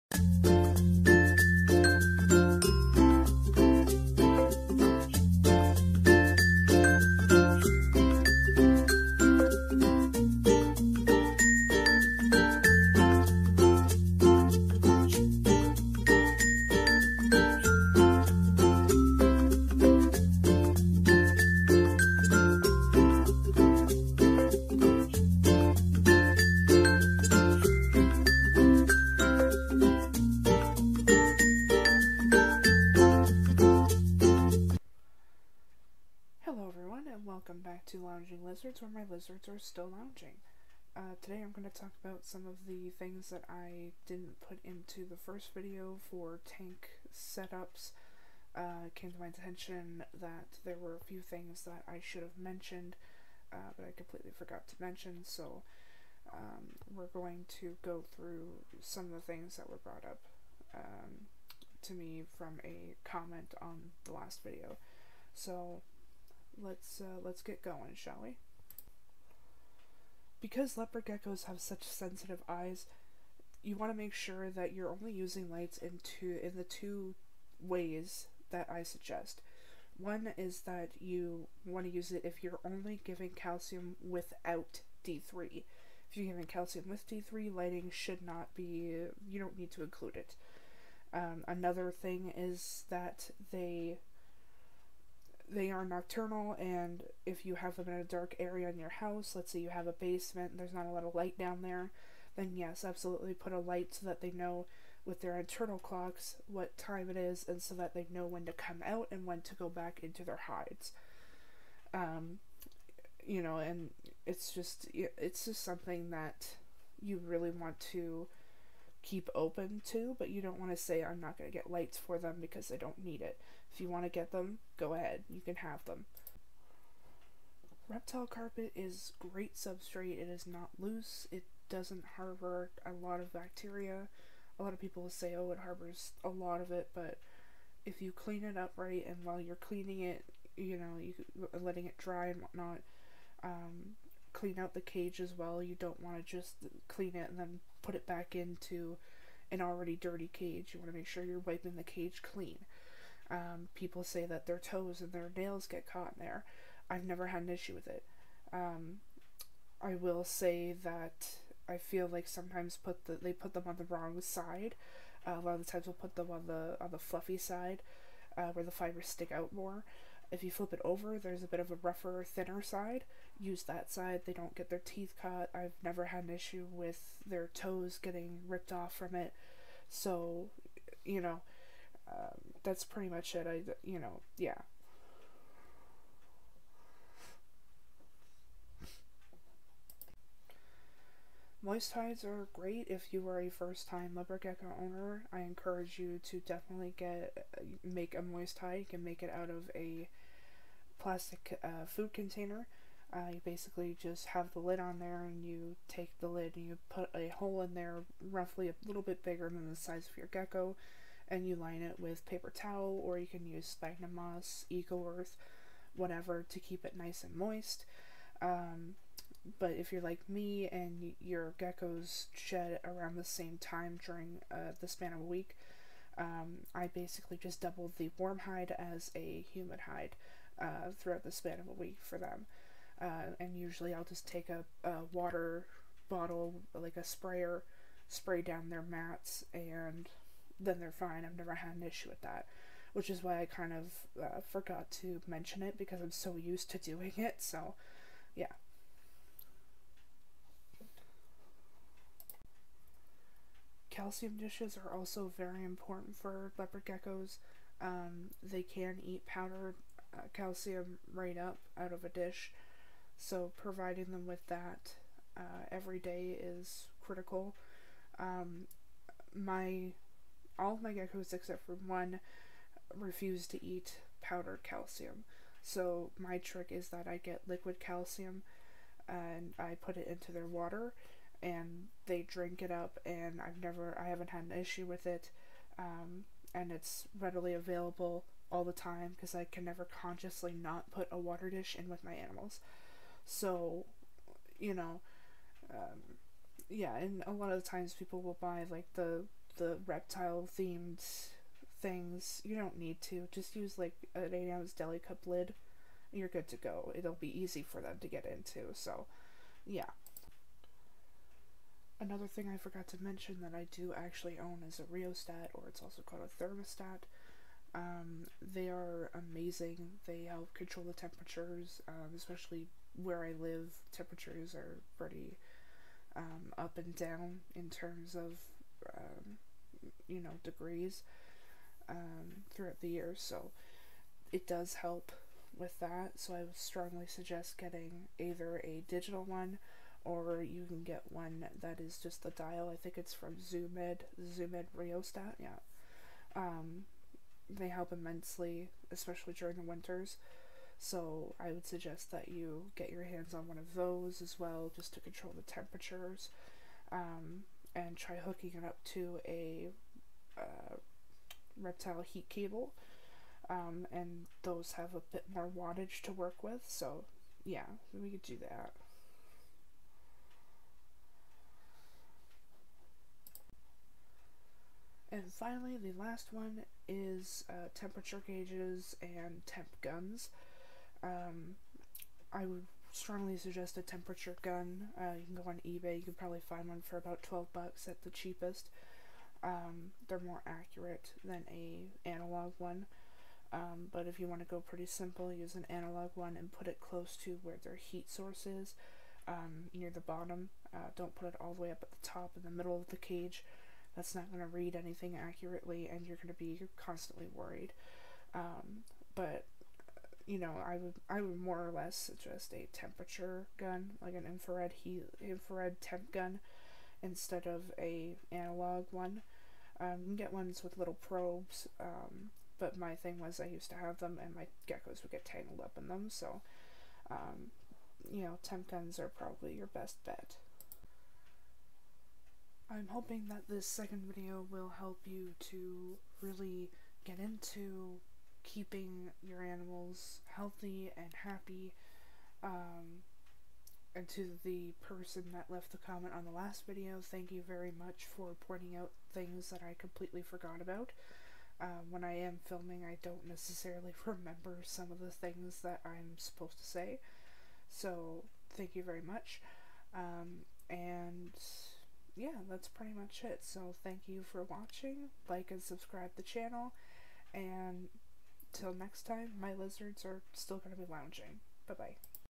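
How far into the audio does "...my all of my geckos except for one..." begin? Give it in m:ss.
4:29.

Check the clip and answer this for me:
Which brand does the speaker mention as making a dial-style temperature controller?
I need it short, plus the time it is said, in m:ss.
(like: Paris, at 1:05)
Zoo Med, at 5:43.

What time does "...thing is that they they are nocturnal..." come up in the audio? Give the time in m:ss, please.
1:32.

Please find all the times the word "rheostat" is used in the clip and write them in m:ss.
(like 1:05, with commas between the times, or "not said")
5:14, 5:44.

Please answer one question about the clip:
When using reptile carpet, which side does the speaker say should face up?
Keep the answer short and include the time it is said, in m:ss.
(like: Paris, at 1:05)
rougher, thinner side, at 2:51.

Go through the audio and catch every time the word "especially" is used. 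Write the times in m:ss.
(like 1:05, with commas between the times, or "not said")
5:22, 5:48.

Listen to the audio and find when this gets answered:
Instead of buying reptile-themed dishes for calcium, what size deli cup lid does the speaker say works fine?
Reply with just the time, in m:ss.
5:04.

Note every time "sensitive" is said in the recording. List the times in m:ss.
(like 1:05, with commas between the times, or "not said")
1:11.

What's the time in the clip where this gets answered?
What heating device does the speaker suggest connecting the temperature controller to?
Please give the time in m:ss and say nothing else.
6:01.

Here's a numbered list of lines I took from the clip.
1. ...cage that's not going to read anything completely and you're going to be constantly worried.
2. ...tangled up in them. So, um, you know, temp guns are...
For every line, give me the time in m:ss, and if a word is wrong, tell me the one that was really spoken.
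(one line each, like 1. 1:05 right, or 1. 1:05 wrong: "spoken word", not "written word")
1. 6:42 wrong: "accurately", not "completely"
2. 7:05 right.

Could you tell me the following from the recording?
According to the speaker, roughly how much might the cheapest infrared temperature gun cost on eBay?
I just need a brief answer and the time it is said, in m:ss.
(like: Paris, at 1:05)
12 dollars, at 6:27.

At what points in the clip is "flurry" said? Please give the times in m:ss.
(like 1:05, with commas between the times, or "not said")
not said.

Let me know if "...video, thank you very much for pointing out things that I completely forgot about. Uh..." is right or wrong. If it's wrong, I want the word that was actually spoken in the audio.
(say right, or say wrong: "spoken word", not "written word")
right.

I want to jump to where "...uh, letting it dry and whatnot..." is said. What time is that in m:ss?
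2:21.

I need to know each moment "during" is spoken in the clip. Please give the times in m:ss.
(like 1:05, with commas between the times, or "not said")
3:44, 5:49.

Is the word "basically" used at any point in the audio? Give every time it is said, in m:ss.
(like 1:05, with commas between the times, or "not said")
3:23, 3:46.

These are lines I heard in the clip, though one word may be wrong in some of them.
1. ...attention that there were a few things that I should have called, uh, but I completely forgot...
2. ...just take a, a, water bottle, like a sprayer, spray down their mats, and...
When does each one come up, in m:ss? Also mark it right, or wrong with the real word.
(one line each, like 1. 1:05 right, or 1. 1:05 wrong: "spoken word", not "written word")
1. 0:49 wrong: "mentioned", not "called"
2. 3:54 right.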